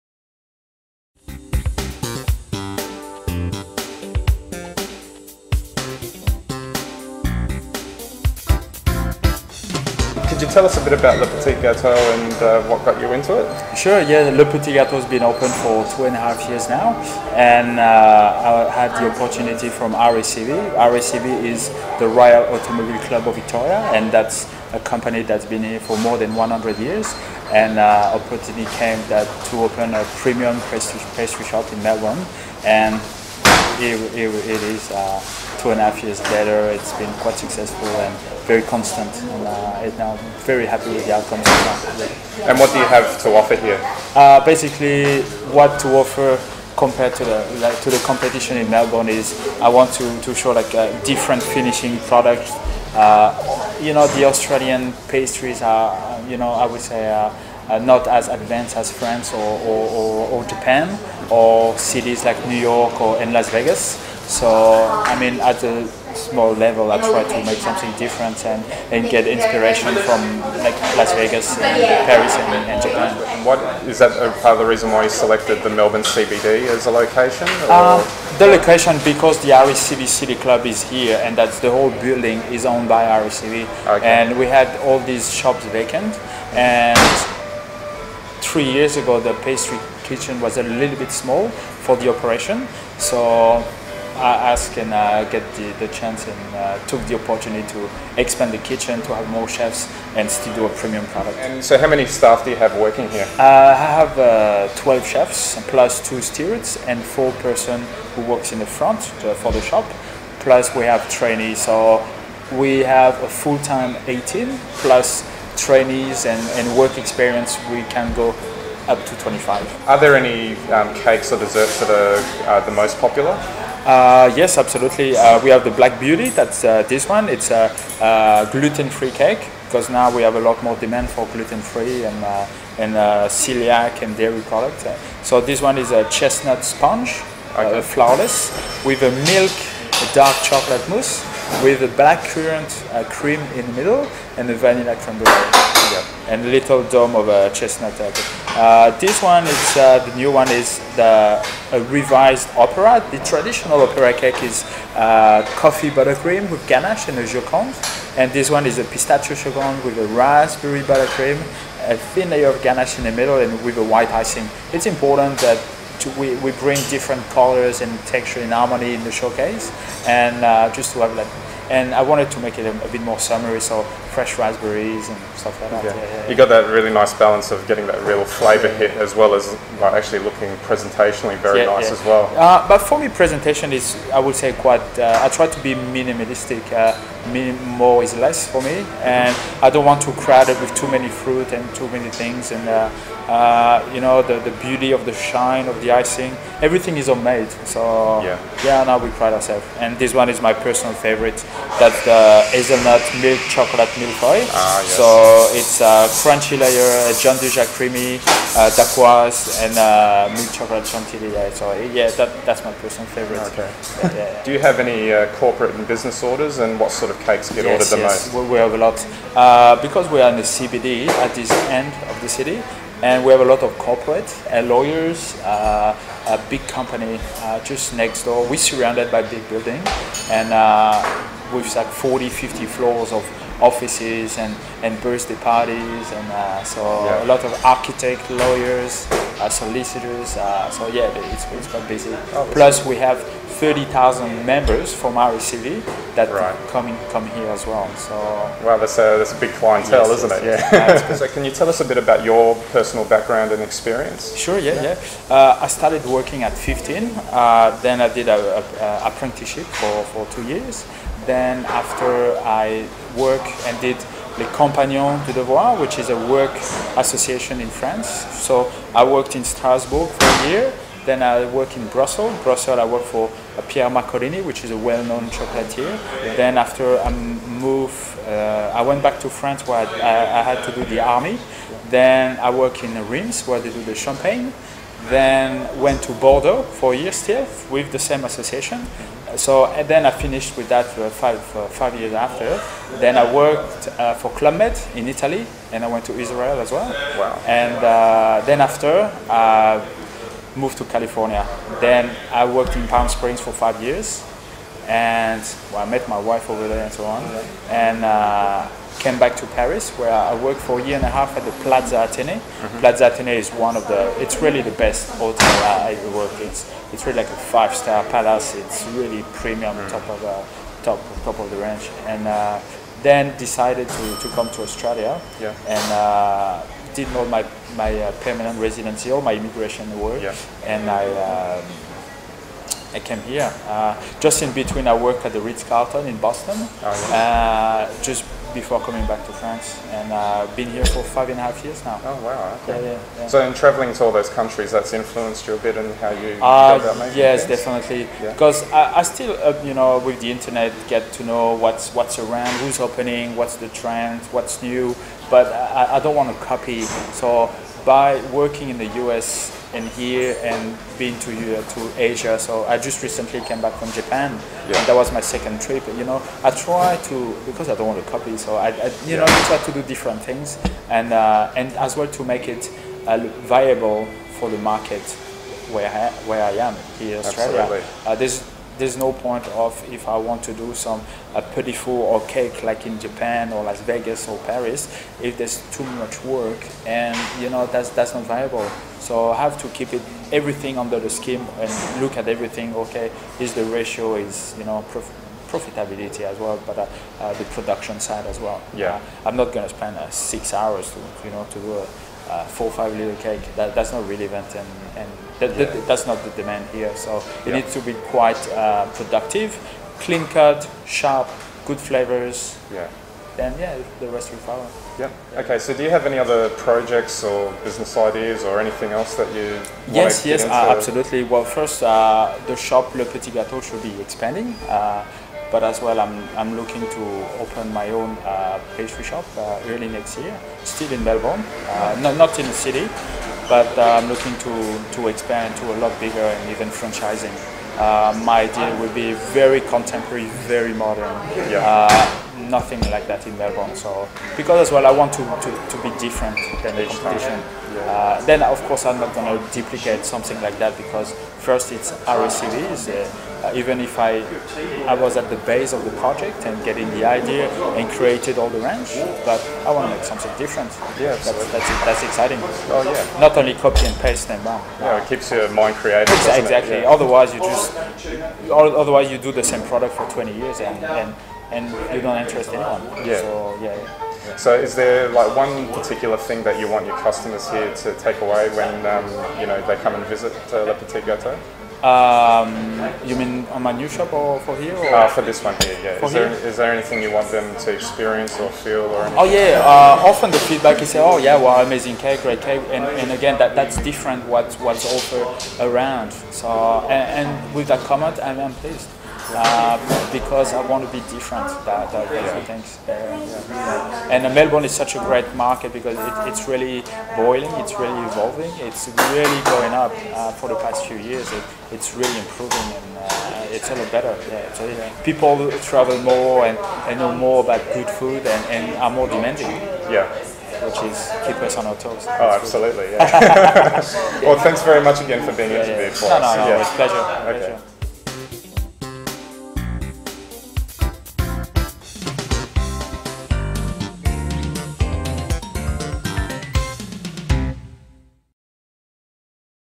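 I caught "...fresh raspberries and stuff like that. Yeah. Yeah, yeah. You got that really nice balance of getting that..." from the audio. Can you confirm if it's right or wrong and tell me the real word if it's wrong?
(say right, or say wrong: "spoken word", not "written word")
right.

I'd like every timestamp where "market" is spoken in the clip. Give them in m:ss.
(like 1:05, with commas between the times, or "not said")
6:14, 8:25.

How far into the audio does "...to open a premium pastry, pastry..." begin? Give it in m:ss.
0:29.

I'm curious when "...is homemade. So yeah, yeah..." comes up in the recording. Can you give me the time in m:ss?
3:16.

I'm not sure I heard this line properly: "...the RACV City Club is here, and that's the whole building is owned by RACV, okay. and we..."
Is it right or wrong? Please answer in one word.
right.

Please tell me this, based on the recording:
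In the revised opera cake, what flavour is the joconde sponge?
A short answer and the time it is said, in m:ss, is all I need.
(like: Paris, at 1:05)
Pistachio, at 2:38.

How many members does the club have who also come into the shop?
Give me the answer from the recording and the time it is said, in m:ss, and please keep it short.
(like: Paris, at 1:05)
30,000, at 4:03.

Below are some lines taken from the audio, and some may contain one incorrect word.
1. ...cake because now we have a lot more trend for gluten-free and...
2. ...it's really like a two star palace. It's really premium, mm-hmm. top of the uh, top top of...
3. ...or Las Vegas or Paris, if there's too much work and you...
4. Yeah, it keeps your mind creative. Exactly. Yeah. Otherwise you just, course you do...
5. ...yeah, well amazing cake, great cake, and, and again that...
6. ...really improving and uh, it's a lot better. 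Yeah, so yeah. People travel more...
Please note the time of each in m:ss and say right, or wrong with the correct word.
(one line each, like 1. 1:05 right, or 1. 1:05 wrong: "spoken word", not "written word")
1. 2:09 wrong: "demand", not "trend"
2. 5:16 wrong: "five", not "two"
3. 6:23 right
4. 7:44 wrong: "otherwise", not "course"
5. 8:11 right
6. 8:31 right.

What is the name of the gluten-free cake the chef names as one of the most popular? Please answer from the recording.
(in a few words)
Black Beauty.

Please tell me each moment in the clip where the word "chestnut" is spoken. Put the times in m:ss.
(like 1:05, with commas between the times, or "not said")
2:16, 2:27.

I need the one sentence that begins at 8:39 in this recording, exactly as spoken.
Yeah which is keep us on our toes.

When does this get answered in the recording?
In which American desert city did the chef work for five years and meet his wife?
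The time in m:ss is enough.
5:02.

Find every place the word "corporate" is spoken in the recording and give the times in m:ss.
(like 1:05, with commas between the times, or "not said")
3:35, 3:43.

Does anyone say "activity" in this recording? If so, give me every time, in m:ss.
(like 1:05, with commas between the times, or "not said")
not said.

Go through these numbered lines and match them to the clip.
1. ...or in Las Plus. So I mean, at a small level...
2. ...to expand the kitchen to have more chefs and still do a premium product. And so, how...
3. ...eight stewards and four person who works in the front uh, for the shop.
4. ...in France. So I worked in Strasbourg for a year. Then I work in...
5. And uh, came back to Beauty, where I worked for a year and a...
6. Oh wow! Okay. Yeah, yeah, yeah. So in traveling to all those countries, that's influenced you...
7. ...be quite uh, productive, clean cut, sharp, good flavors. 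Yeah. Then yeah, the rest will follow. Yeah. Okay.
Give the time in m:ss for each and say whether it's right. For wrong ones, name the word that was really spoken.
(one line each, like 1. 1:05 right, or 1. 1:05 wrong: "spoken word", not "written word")
1. 1:02 wrong: "Vegas", not "Plus"
2. 1:37 right
3. 1:46 wrong: "two", not "eight"
4. 4:27 right
5. 5:07 wrong: "Paris", not "Beauty"
6. 5:42 right
7. 6:47 right.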